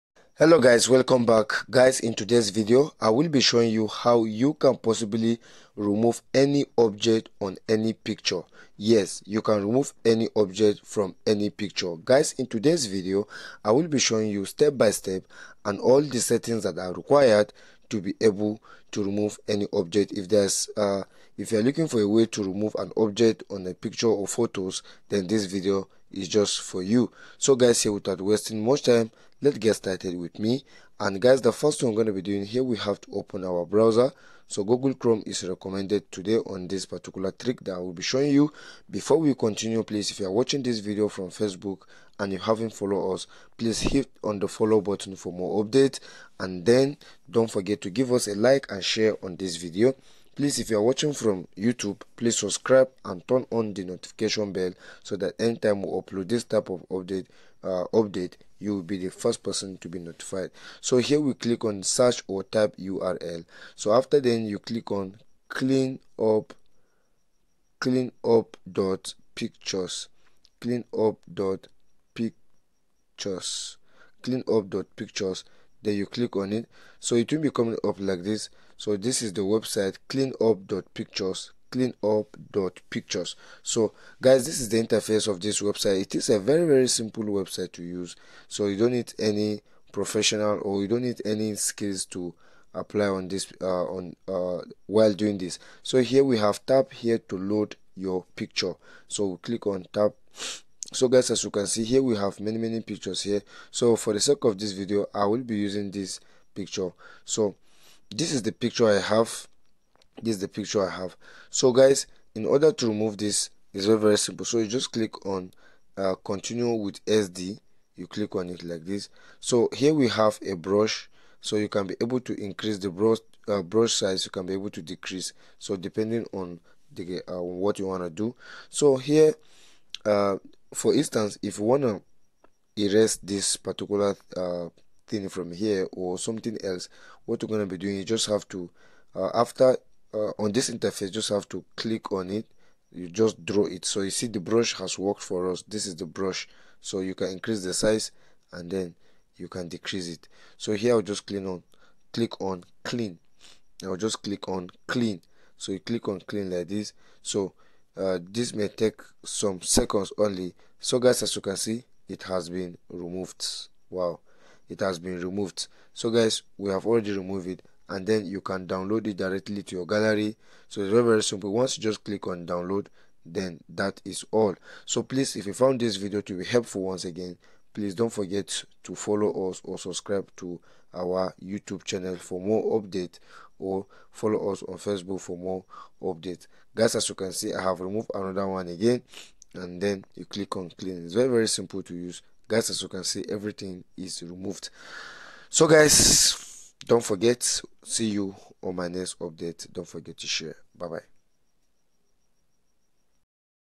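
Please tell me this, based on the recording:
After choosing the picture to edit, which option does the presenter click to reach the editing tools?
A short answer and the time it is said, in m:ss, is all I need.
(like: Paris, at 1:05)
Continue with SD, at 1:56.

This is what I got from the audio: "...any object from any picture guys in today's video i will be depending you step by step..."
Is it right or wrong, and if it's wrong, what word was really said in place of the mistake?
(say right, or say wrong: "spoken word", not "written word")
wrong: "showing", not "depending".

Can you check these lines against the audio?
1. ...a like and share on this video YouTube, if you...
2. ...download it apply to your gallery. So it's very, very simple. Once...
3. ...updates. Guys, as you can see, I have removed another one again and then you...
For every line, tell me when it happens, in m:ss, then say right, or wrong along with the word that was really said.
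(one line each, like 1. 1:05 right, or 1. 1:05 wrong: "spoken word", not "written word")
1. 0:48 wrong: "Please", not "YouTube"
2. 2:48 wrong: "directly", not "apply"
3. 3:06 right.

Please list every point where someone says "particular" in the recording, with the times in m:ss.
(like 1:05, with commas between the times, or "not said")
0:36, 2:13.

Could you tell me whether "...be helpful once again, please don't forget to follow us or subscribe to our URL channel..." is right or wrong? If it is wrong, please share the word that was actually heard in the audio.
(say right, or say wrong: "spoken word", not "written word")
wrong: "YouTube", not "URL".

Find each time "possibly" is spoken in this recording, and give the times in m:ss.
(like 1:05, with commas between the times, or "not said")
0:04.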